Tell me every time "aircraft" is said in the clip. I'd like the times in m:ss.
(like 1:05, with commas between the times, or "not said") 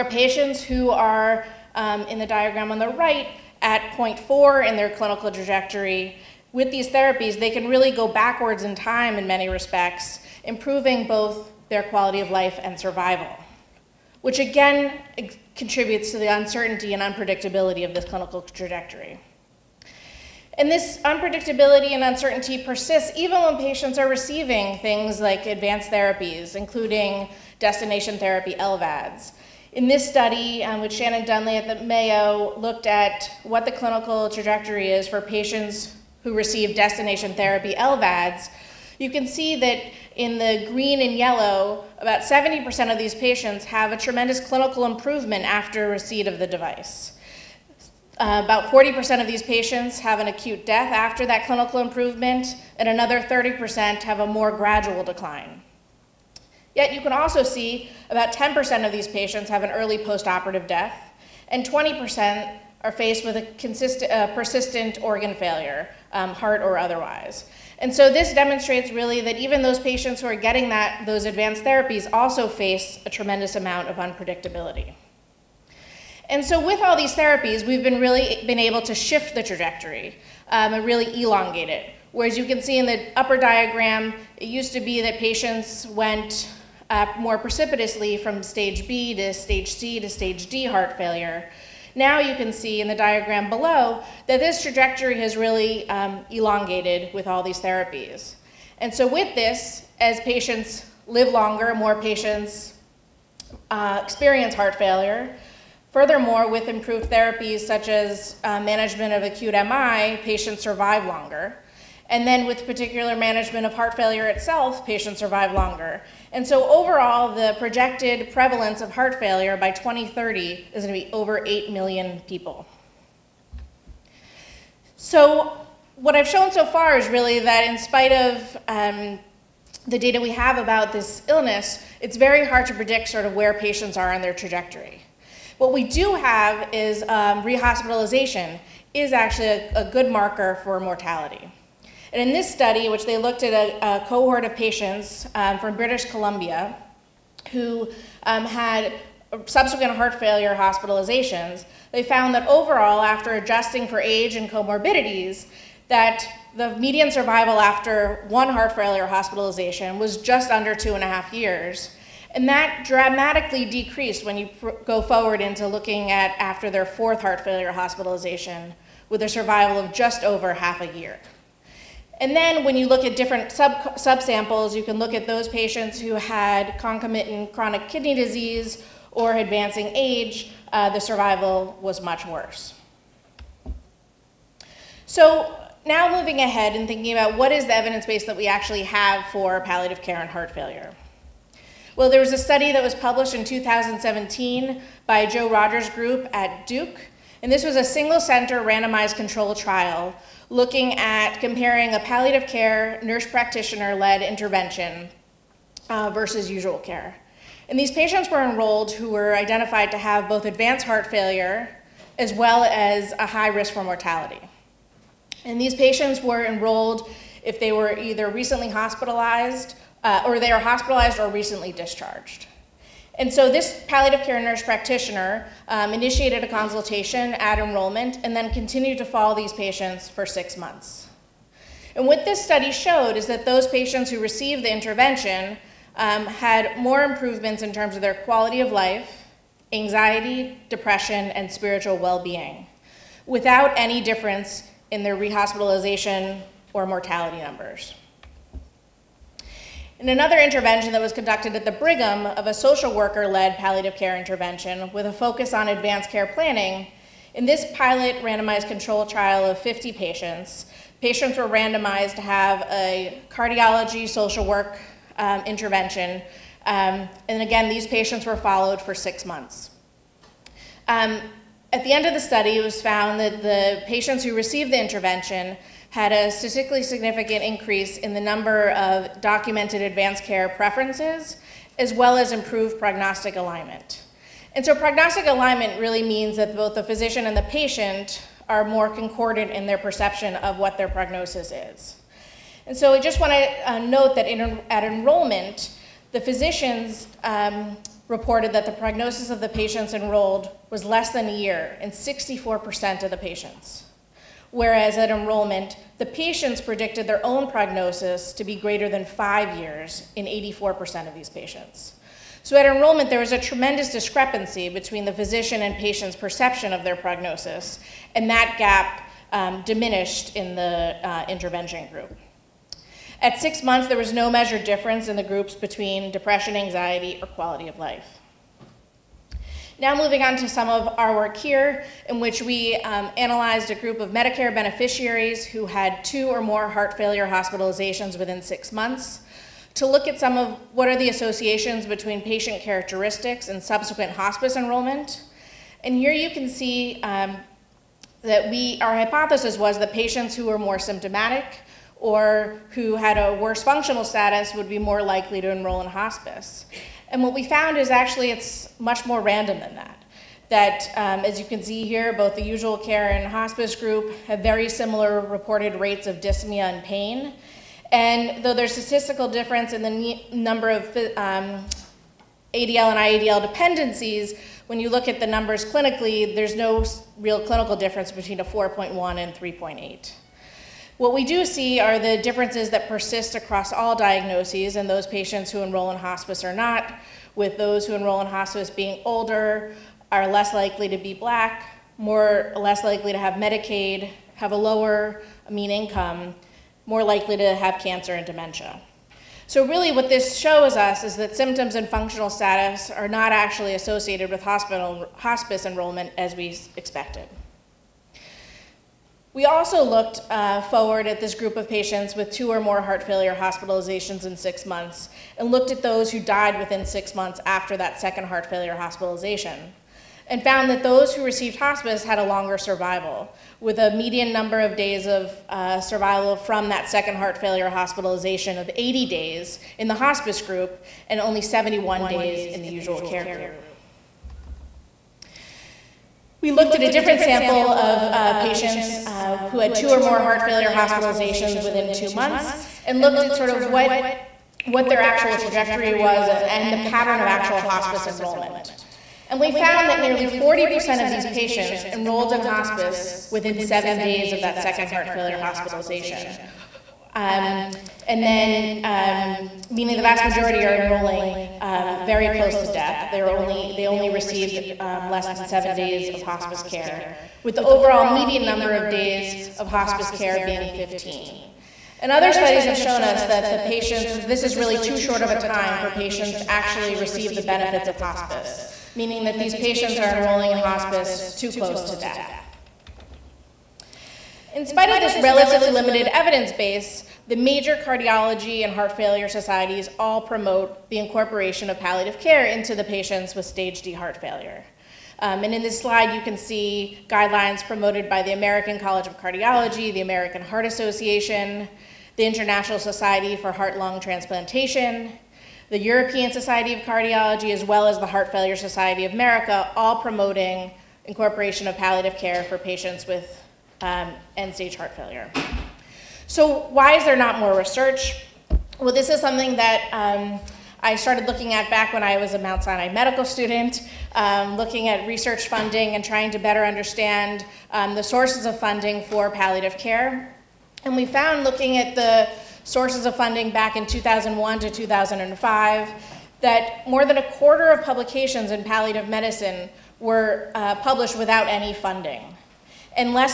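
not said.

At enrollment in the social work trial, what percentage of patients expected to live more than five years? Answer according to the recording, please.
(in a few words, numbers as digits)
84%.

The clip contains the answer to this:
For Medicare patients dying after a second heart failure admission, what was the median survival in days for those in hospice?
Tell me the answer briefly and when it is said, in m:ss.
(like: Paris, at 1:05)
80, at 7:08.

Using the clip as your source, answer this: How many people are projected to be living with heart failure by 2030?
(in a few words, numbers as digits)
over 8 million.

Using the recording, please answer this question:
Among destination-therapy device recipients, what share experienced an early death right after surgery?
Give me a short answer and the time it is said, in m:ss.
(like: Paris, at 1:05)
10%, at 0:58.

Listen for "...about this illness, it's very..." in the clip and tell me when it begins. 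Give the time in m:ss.
2:10.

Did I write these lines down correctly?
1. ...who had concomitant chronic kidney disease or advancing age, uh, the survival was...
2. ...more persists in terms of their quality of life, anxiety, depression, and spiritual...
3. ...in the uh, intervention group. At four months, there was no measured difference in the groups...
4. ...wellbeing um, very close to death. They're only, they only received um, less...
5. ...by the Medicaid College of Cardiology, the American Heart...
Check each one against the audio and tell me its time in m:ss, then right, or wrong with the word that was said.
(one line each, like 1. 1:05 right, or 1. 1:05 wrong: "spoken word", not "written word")
1. 2:55 right
2. 3:56 wrong: "improvements", not "persists"
3. 5:20 wrong: "six", not "four"
4. 7:40 wrong: "enrolling", not "wellbeing"
5. 8:18 wrong: "American", not "Medicaid".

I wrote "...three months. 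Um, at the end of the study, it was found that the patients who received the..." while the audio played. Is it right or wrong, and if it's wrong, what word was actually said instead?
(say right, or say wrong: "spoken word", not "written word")
wrong: "six", not "three".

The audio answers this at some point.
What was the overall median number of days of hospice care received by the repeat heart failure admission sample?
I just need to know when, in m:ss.
7:50.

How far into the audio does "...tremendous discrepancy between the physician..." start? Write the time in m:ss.
5:13.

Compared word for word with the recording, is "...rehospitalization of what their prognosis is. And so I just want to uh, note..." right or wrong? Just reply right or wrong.
wrong.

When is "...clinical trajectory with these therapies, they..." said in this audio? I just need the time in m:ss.
0:04.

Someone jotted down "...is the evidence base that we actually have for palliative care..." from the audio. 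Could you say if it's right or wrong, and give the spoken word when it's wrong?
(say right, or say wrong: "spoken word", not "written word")
right.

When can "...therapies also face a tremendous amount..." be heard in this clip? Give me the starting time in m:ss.
1:11.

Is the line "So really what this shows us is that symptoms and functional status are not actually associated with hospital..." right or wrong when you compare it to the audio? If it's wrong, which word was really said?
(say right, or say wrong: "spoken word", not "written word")
right.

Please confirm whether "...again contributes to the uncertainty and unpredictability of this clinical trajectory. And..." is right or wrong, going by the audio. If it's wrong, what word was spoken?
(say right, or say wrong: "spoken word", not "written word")
right.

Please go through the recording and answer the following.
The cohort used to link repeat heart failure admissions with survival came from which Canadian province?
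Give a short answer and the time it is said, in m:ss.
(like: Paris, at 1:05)
British Columbia, at 2:25.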